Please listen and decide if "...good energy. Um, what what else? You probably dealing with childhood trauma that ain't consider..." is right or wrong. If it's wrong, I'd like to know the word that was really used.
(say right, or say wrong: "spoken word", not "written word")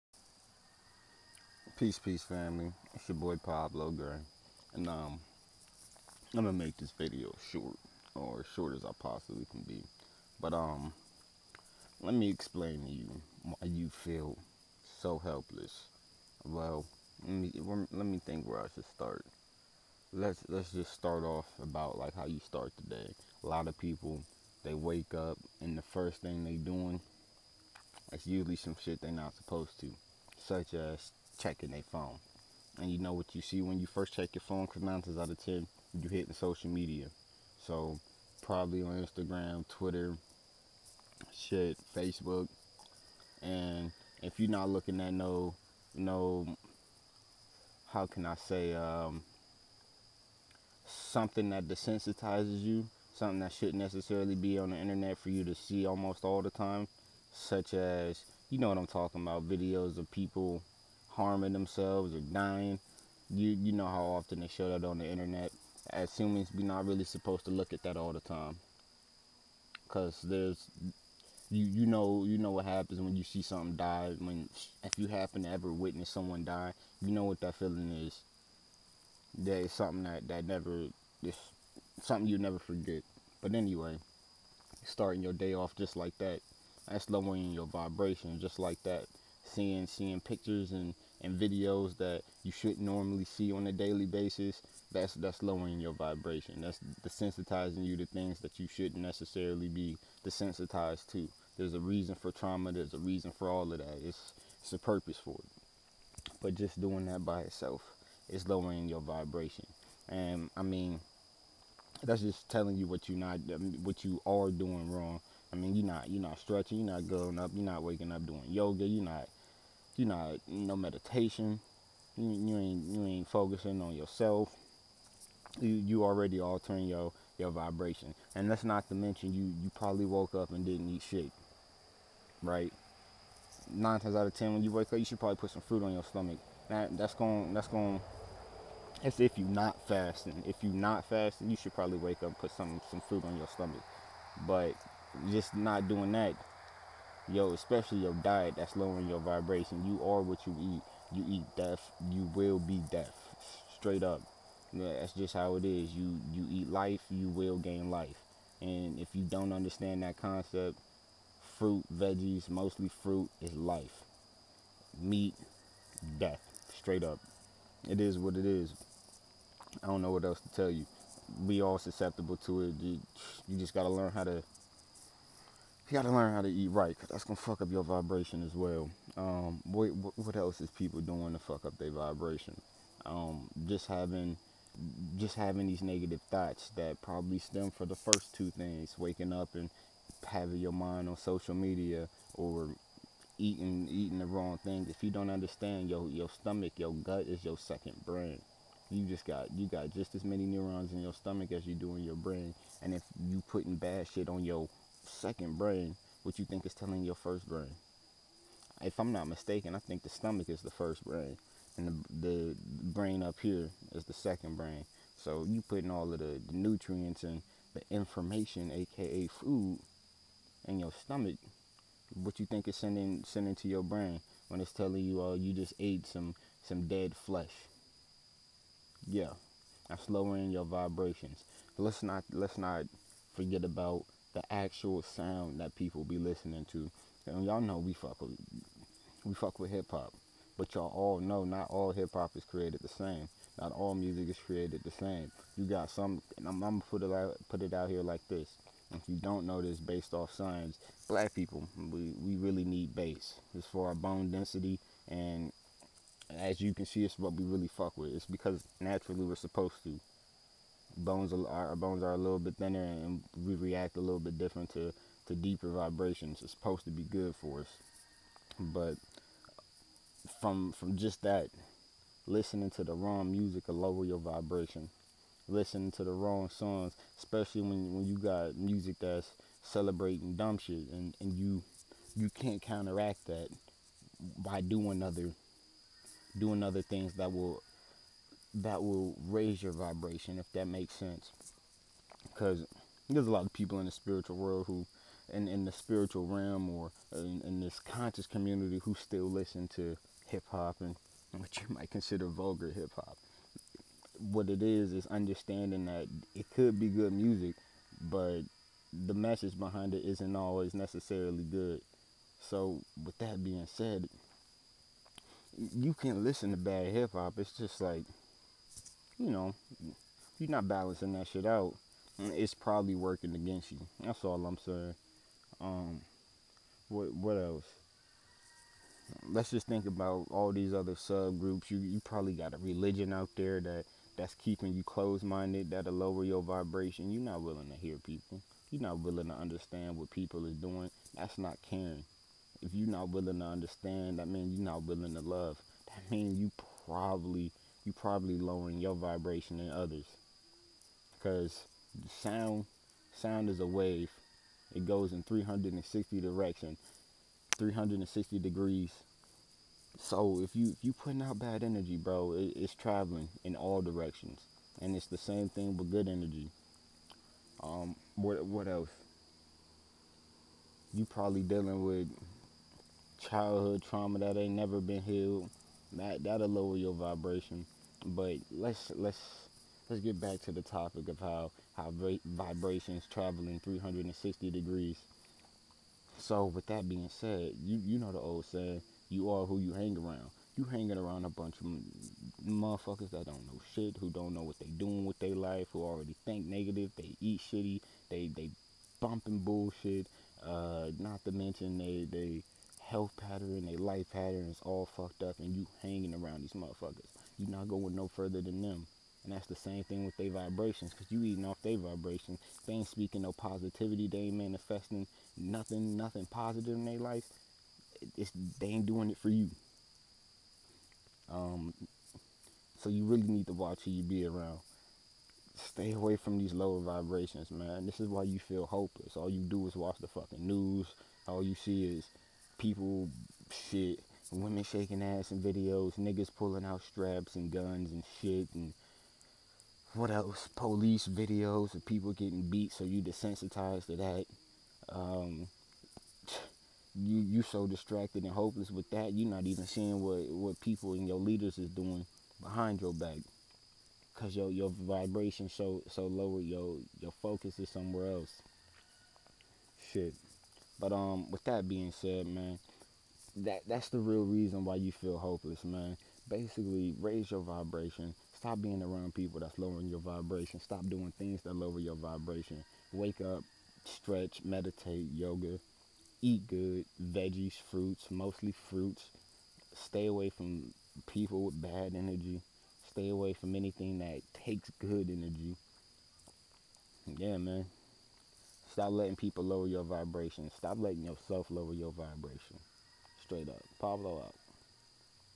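wrong: "never", not "consider".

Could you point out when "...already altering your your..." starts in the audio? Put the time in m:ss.
2:06.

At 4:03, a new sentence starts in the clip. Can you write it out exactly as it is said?
Not all music is created the same.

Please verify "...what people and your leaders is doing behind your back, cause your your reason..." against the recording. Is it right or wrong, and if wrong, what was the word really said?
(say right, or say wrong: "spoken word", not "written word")
wrong: "vibration", not "reason".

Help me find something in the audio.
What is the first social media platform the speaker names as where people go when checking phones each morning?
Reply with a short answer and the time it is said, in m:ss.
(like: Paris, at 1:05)
Instagram, at 0:39.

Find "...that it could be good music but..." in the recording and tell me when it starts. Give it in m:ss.
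5:05.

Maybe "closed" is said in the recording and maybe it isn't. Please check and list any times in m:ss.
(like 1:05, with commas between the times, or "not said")
5:34.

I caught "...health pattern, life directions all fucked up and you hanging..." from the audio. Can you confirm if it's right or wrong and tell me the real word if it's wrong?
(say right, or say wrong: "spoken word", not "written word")
wrong: "patterns", not "directions".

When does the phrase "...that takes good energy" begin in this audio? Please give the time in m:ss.
8:03.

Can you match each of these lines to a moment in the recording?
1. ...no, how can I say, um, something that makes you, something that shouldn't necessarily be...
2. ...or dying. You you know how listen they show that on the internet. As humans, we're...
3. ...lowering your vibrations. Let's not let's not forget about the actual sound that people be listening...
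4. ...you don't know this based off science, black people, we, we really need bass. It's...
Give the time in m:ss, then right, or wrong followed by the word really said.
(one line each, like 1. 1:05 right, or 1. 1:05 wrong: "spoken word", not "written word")
1. 0:45 wrong: "desensitizes", not "makes"
2. 1:02 wrong: "often", not "listen"
3. 3:50 right
4. 4:09 right.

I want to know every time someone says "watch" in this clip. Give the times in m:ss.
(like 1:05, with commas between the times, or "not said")
7:03, 7:09.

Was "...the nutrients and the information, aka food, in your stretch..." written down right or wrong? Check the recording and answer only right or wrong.
wrong.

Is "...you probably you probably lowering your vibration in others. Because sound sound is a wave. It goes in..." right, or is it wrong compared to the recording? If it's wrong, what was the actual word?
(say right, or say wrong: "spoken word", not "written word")
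right.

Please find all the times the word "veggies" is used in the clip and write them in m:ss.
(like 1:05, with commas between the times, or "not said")
2:41, 7:57.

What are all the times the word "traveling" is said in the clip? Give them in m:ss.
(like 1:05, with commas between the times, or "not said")
6:02, 6:23.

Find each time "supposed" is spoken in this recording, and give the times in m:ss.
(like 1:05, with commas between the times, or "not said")
0:29, 1:07, 4:19, 4:26.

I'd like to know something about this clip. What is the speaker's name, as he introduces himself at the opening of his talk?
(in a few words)
Pablo Gray.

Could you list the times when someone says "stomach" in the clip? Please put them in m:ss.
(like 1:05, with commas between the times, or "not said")
2:16, 2:23, 3:16, 3:21, 3:30, 3:40.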